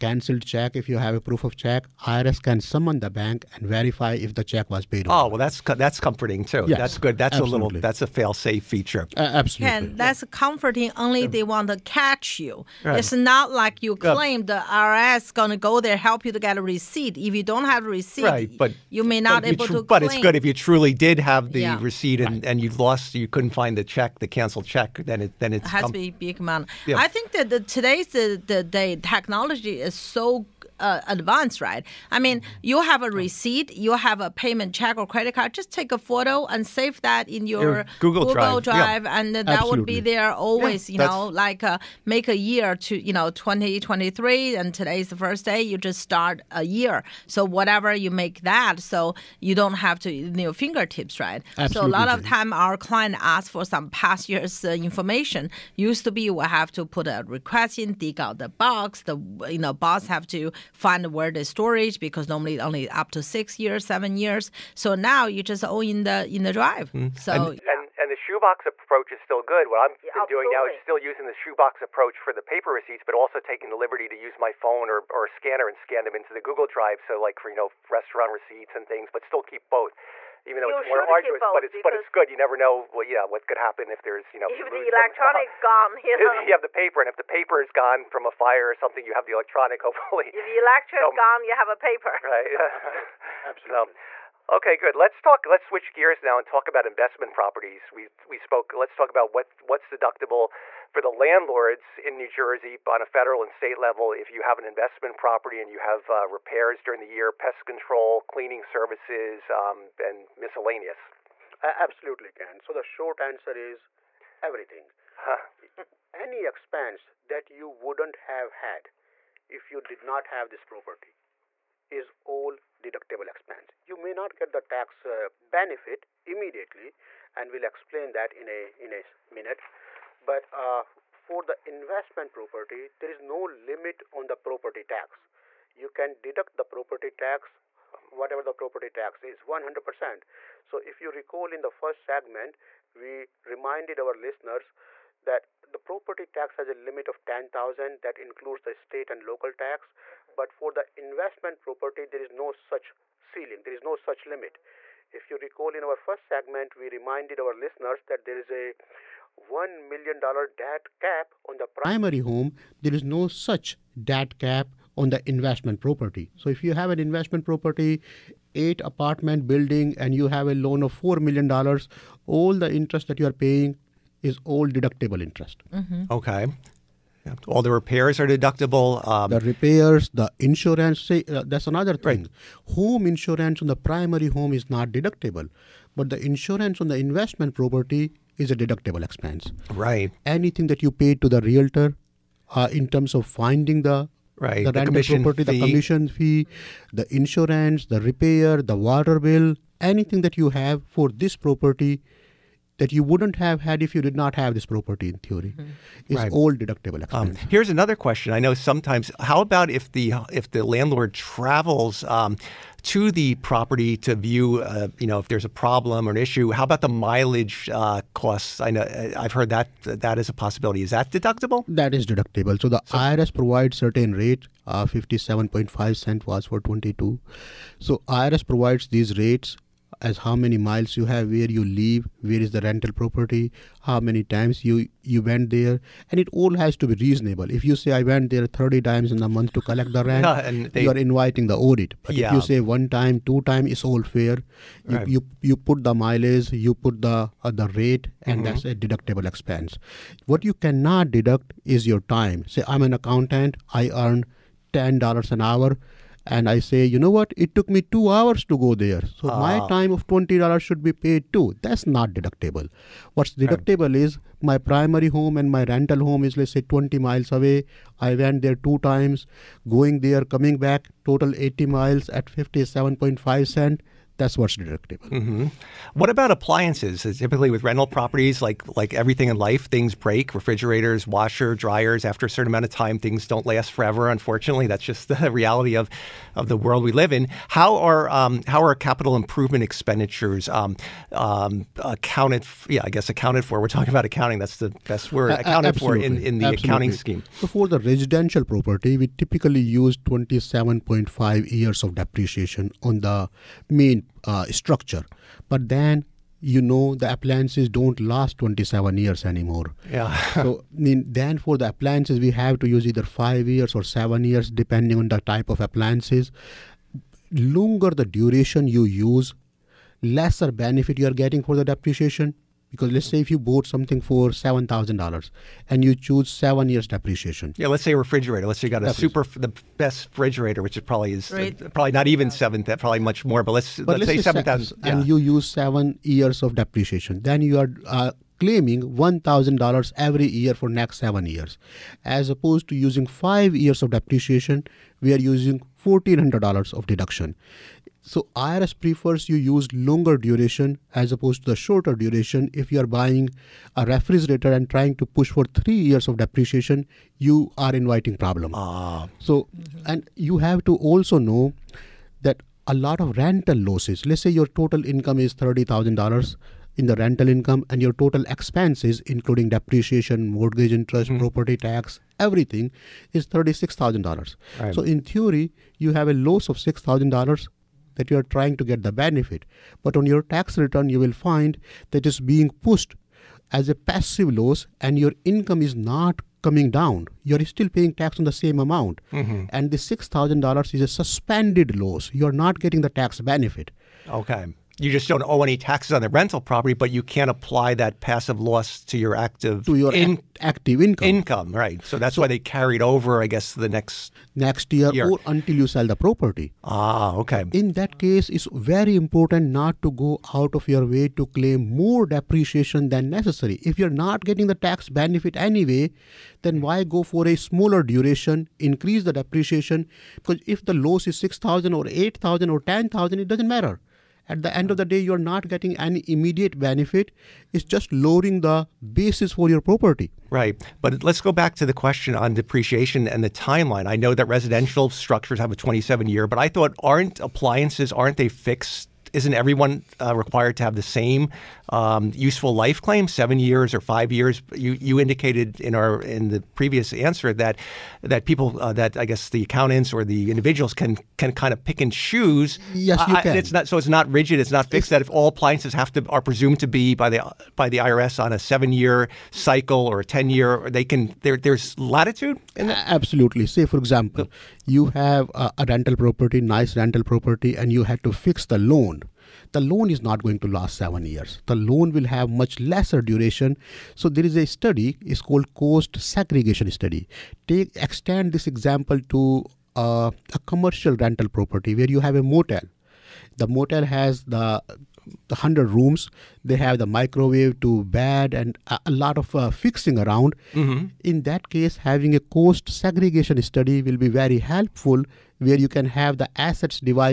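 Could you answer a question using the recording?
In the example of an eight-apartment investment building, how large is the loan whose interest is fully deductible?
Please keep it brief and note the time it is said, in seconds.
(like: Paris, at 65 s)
$4 million, at 170 s.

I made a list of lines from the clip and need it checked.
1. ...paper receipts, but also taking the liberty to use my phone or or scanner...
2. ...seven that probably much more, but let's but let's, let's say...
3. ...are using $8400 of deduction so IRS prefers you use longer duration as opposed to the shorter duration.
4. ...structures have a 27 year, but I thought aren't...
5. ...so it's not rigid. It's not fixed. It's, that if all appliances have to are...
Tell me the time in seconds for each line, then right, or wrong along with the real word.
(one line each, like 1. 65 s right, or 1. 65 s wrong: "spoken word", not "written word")
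1. 72 s right
2. 332 s right
3. 345 s wrong: "1400", not "8400"
4. 434 s right
5. 453 s right.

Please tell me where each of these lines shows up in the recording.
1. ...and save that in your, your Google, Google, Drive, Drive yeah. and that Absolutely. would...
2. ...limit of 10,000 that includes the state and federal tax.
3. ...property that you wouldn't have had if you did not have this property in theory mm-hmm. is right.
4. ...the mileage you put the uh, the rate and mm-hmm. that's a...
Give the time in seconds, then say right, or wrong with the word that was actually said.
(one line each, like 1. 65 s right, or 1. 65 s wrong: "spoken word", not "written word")
1. 36 s right
2. 146 s wrong: "local", not "federal"
3. 201 s right
4. 245 s right.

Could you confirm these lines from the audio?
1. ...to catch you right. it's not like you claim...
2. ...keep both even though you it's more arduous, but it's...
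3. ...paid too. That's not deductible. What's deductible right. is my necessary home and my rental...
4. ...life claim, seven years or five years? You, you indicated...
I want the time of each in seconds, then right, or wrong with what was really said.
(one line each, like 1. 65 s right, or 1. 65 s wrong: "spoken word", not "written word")
1. 11 s right
2. 79 s right
3. 260 s wrong: "primary", not "necessary"
4. 442 s right.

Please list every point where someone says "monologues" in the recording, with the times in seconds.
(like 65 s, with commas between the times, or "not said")
not said.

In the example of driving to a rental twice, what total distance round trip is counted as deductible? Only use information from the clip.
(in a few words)
80 miles.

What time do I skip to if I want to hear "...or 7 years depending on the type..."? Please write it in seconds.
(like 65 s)
313 s.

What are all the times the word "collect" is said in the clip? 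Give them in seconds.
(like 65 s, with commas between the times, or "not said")
239 s.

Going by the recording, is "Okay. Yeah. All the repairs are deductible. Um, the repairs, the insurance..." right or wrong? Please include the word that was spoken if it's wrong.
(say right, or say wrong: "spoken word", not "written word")
right.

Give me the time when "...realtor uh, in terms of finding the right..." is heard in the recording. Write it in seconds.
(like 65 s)
191 s.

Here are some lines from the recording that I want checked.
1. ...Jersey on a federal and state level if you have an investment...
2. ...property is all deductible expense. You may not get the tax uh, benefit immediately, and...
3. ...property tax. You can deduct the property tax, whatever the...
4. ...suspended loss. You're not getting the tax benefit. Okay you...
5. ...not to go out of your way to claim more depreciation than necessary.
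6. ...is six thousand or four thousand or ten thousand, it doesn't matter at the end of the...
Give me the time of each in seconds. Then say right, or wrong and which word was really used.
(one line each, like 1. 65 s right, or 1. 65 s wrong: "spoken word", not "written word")
1. 102 s right
2. 120 s right
3. 134 s right
4. 390 s right
5. 409 s right
6. 421 s wrong: "eight", not "four".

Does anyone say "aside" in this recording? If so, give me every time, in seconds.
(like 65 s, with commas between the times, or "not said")
not said.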